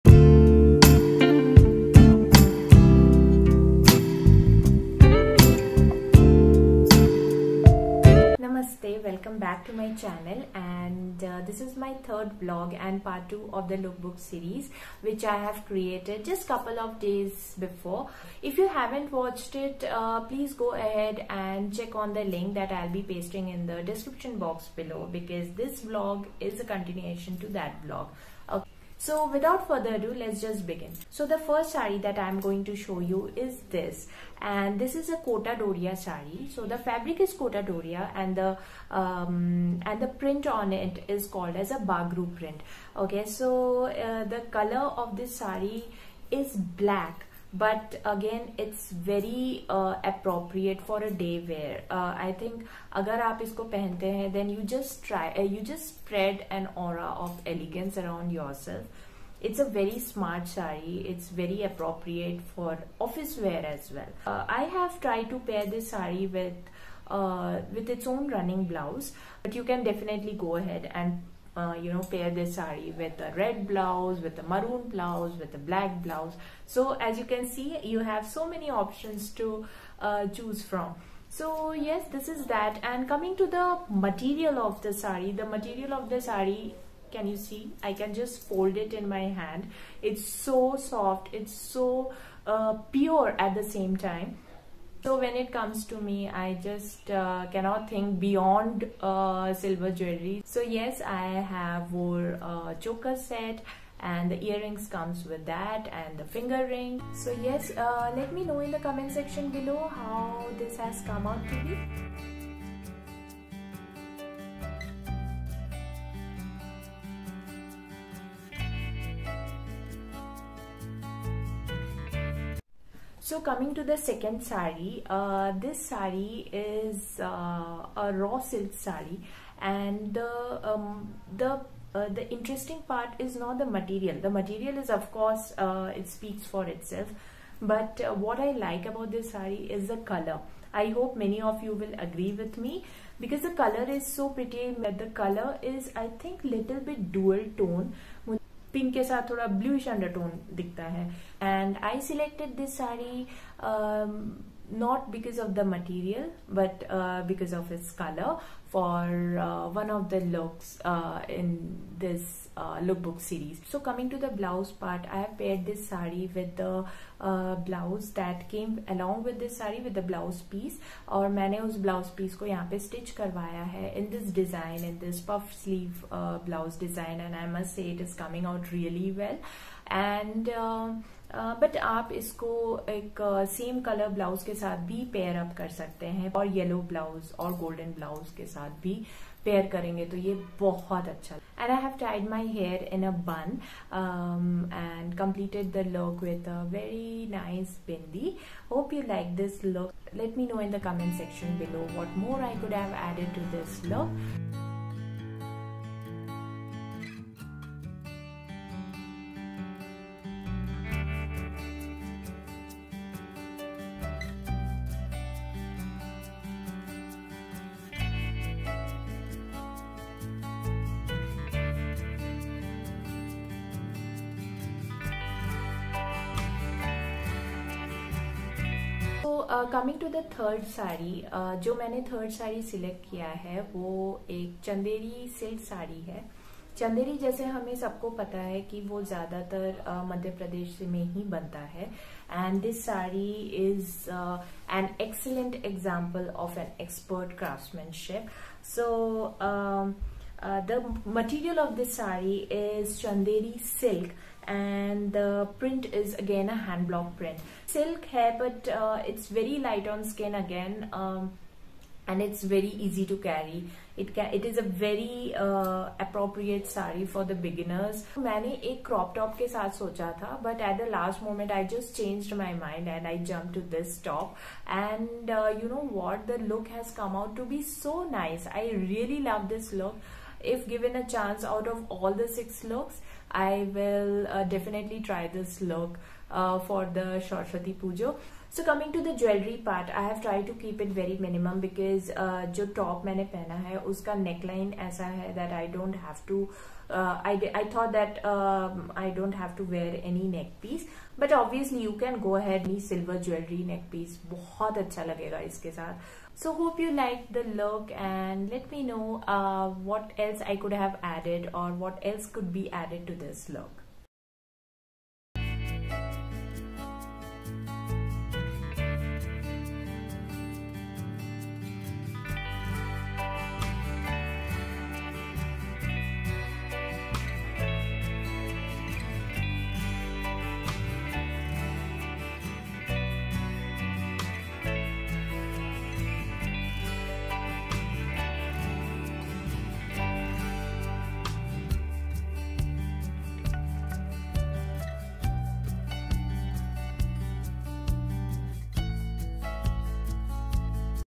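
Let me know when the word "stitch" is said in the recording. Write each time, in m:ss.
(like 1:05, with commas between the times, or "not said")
2:52.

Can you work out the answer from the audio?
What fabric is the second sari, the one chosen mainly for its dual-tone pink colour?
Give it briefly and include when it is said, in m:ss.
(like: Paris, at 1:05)
Raw silk, at 2:08.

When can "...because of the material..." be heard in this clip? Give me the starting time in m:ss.
2:35.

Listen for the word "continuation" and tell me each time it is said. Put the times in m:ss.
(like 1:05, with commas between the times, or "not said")
0:26.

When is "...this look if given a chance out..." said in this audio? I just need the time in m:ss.
4:39.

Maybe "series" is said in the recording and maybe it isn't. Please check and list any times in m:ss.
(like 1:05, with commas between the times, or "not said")
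0:14, 2:43.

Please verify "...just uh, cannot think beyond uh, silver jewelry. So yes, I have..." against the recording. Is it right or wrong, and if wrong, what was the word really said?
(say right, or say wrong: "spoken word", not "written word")
right.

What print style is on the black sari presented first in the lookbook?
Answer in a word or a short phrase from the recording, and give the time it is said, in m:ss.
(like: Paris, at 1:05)
Bagru print, at 0:41.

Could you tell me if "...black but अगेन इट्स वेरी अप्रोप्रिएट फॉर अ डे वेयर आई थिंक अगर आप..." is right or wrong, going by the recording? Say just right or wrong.
right.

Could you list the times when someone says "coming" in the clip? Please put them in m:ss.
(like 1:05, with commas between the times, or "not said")
1:23, 2:03, 2:43, 2:58.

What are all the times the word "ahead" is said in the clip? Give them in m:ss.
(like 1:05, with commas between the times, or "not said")
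0:20, 1:10.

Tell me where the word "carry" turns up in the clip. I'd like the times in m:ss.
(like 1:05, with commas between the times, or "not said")
4:23.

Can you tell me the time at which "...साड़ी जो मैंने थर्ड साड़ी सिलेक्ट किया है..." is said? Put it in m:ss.
3:50.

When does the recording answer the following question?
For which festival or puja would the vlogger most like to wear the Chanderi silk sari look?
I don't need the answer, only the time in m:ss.
4:47.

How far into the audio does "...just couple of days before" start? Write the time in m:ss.
0:16.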